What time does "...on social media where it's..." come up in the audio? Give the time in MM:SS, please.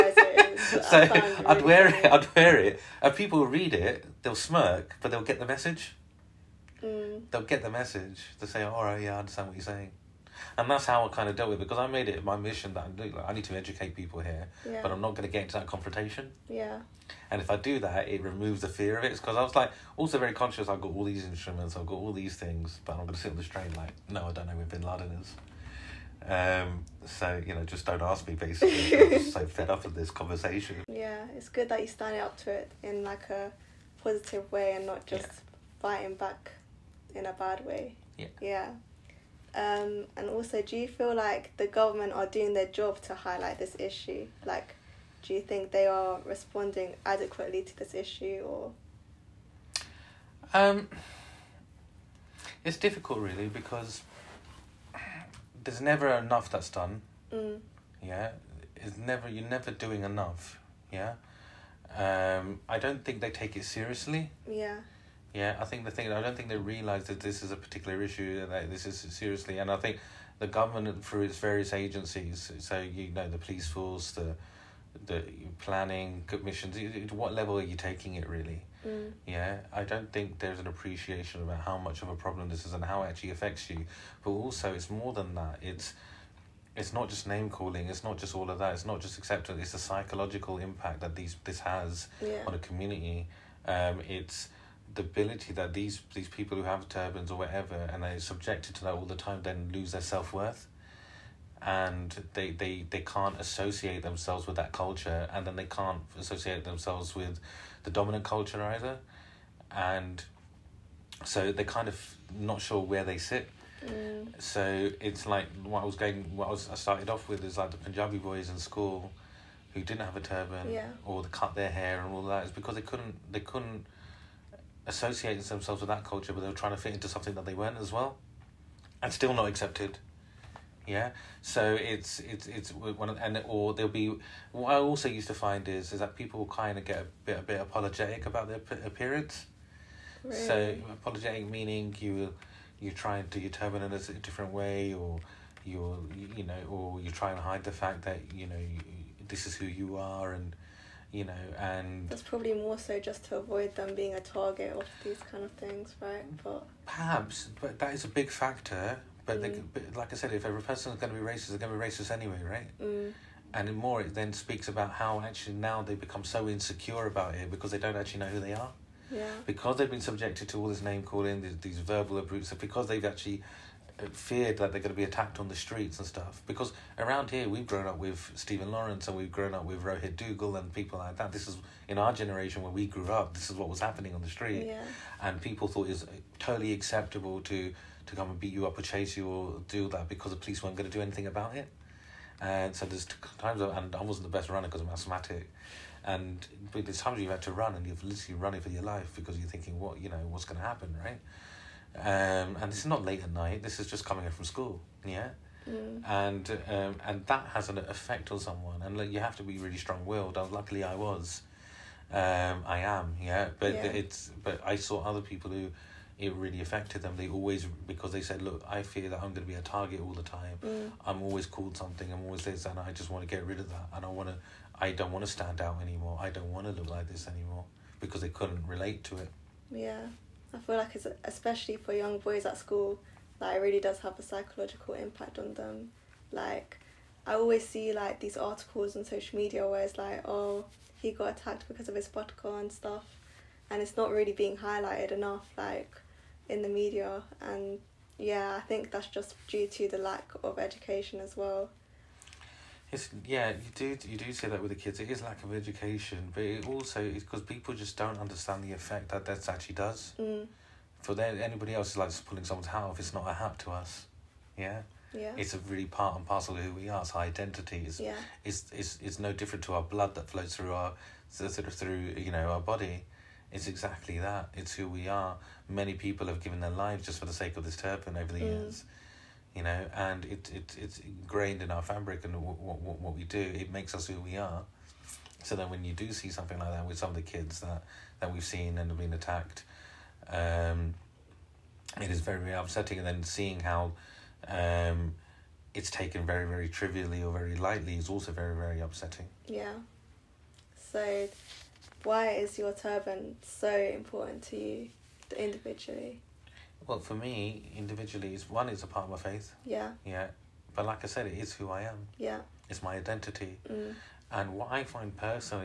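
03:58.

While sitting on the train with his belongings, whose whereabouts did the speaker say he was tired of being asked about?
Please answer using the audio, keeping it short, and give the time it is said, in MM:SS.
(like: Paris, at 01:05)
Bin Laden, at 00:24.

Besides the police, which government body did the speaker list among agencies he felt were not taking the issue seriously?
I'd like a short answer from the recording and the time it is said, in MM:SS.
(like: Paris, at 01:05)
planning commissions, at 01:15.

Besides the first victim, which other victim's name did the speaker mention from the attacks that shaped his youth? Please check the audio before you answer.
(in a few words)
Rohit Duggal.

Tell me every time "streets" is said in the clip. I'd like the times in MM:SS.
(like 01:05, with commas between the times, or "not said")
02:55, 03:04.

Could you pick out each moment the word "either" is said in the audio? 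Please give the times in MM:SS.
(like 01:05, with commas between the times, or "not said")
01:48.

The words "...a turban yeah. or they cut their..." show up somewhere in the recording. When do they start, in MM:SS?
02:00.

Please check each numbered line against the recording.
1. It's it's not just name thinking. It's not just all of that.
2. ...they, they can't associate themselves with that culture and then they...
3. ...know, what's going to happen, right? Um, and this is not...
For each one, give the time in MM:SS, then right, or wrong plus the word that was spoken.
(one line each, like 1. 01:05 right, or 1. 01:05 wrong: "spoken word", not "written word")
1. 01:25 wrong: "calling", not "thinking"
2. 01:42 right
3. 03:20 right.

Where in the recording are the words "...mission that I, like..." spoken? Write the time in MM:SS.
00:12.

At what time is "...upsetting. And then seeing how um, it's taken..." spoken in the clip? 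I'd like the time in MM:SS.
04:52.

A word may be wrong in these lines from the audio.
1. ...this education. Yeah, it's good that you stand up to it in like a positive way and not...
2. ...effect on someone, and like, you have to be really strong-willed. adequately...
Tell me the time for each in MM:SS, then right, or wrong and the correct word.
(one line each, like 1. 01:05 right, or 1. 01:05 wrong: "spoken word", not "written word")
1. 00:29 wrong: "conversation", not "education"
2. 03:27 wrong: "luckily", not "adequately".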